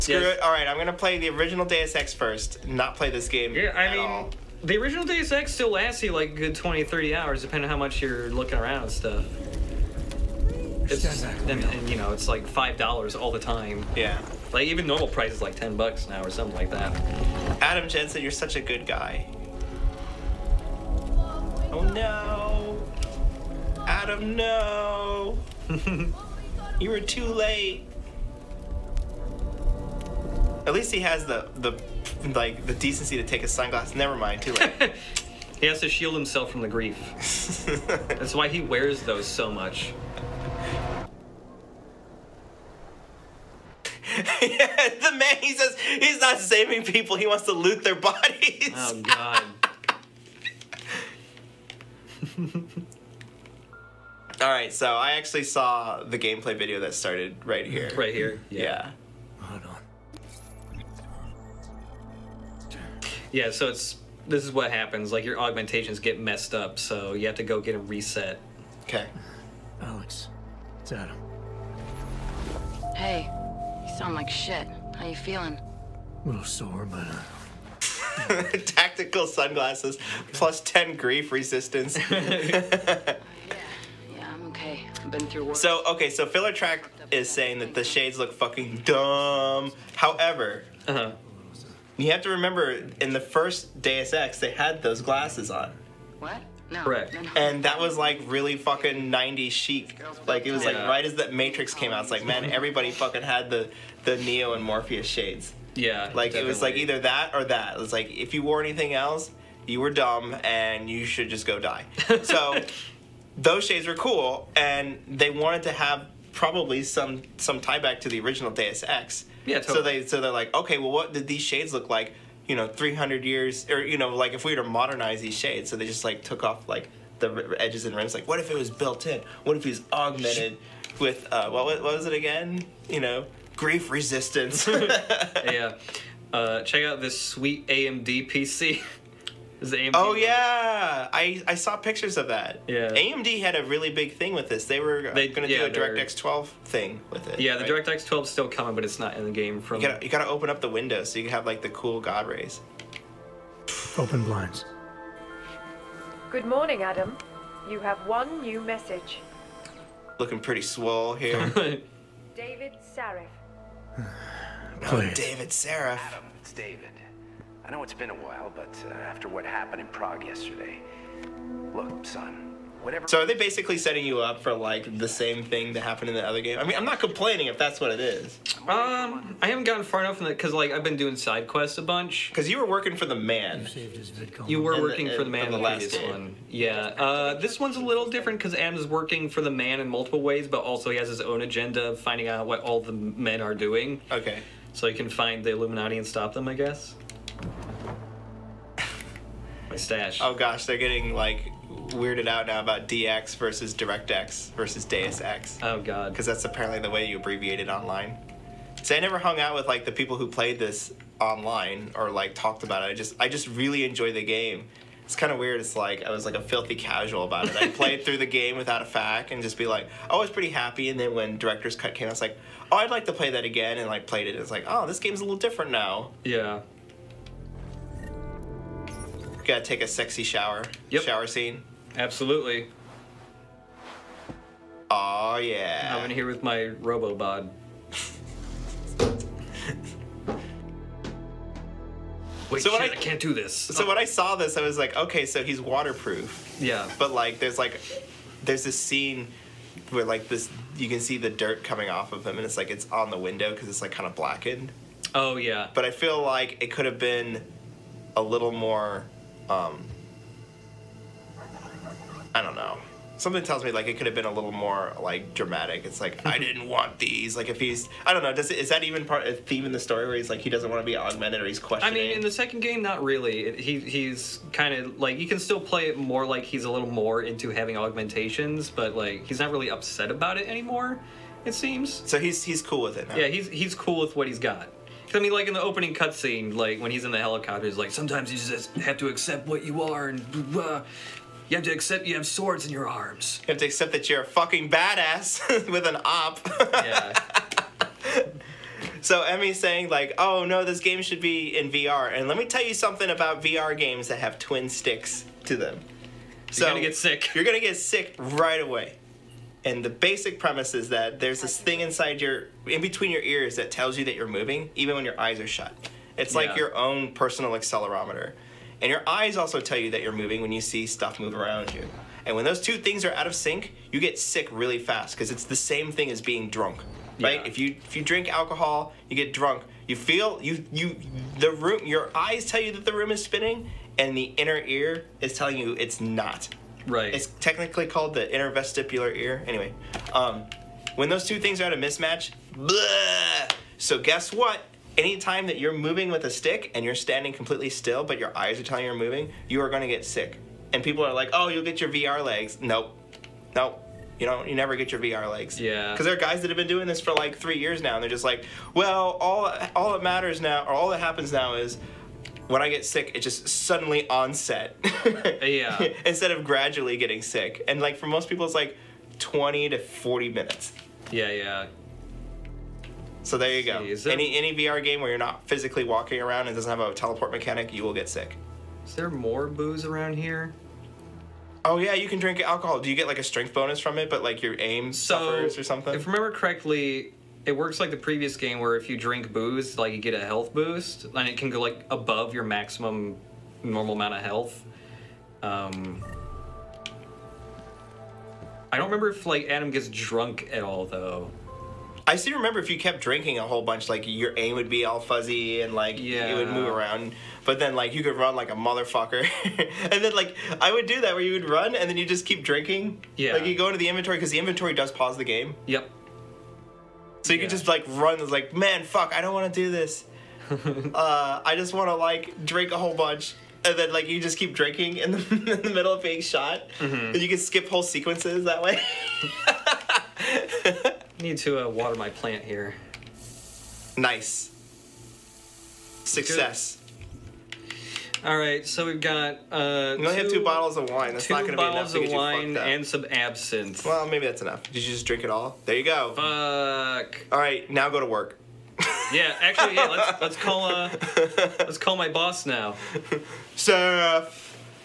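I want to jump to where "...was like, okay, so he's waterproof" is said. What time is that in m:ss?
4:04.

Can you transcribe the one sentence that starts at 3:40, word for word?
And then when Director's Cut came, I was like, oh, I'd like to play that again.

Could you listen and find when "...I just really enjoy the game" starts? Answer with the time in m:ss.
3:33.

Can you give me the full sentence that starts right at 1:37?
And that was like really fucking 90s chic.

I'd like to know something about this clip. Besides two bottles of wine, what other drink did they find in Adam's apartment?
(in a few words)
absinthe.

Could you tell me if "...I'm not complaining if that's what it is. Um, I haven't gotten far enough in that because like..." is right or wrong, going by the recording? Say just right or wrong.
right.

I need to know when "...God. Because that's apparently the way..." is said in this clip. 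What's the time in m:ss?
3:25.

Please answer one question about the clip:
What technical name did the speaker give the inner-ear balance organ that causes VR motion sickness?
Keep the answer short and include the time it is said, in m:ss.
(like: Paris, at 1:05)
inner vestibular ear, at 5:38.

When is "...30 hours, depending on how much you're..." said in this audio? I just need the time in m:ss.
0:06.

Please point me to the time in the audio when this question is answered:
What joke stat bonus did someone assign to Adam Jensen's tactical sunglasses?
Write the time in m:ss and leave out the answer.
1:20.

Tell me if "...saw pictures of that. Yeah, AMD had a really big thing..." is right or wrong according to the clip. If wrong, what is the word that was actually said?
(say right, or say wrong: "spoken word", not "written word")
right.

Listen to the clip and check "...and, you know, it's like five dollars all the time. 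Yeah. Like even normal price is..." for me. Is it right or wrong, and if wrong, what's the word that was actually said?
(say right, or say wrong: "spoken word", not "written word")
right.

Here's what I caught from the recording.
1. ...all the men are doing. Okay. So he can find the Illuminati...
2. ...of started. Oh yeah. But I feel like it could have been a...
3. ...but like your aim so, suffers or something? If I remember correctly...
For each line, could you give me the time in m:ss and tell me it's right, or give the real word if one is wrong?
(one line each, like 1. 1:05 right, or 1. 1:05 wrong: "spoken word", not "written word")
1. 3:12 right
2. 4:14 wrong: "blackened", not "started"
3. 6:24 right.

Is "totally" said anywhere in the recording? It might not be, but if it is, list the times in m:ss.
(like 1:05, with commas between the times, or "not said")
1:59.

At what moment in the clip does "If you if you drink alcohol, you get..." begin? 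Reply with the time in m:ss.
5:27.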